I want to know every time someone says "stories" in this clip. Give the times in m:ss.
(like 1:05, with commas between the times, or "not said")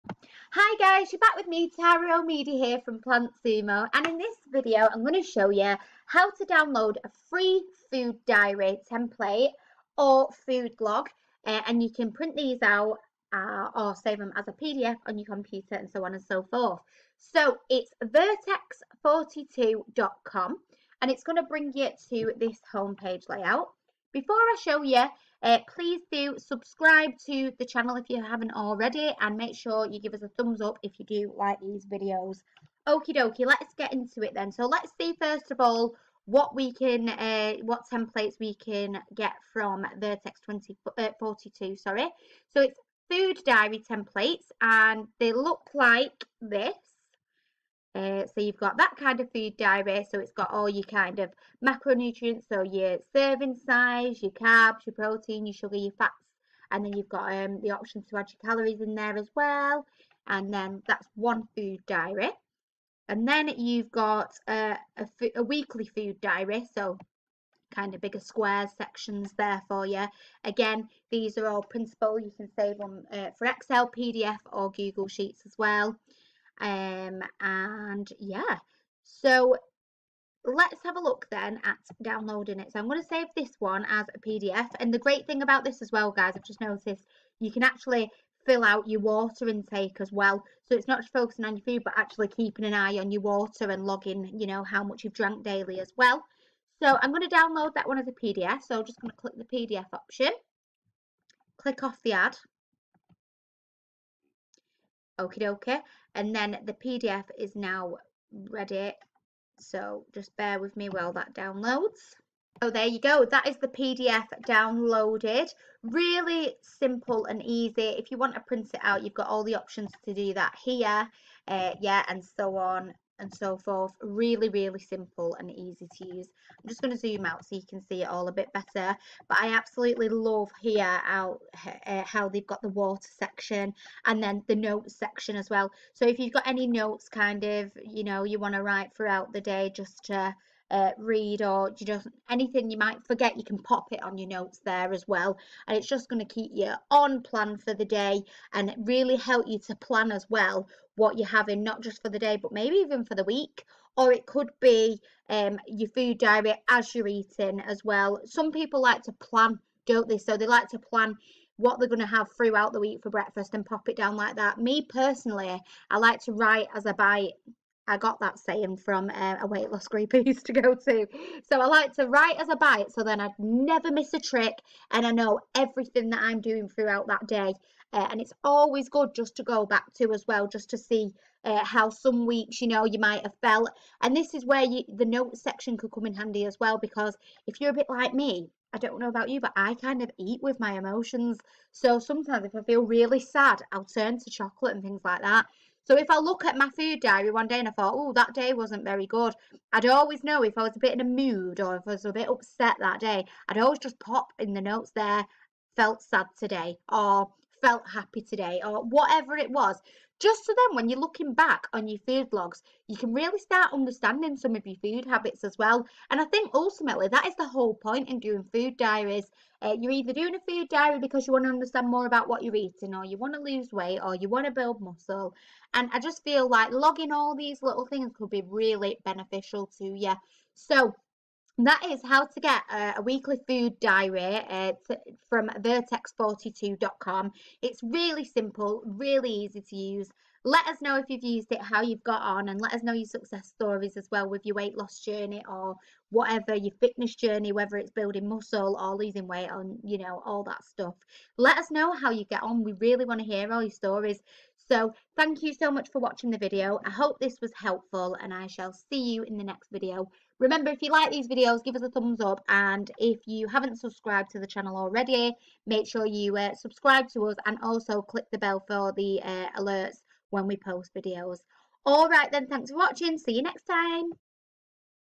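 4:03, 4:13.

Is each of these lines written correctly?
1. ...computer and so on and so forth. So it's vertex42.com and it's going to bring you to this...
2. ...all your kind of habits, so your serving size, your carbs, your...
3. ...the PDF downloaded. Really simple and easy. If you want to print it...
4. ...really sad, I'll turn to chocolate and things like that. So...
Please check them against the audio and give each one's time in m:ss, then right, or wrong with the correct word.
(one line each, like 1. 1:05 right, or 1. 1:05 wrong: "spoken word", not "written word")
1. 0:15 right
2. 0:50 wrong: "macronutrients", not "habits"
3. 1:53 right
4. 3:12 right.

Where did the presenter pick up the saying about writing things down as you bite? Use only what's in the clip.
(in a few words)
A weight loss group.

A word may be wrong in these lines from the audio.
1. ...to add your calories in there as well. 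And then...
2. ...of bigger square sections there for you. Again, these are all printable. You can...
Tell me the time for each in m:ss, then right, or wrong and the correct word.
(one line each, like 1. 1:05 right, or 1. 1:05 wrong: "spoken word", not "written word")
1. 0:58 right
2. 1:07 right.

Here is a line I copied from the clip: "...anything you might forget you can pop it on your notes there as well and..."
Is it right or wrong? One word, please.
right.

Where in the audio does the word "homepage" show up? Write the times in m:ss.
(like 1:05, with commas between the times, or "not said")
0:22.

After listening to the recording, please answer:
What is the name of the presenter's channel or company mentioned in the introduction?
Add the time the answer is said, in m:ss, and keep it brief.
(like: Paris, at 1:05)
PlantSumo, at 0:02.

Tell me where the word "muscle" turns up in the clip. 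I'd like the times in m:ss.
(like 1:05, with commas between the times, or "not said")
3:44, 4:08.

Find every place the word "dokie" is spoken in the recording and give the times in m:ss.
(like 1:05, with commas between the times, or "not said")
0:33, 1:45.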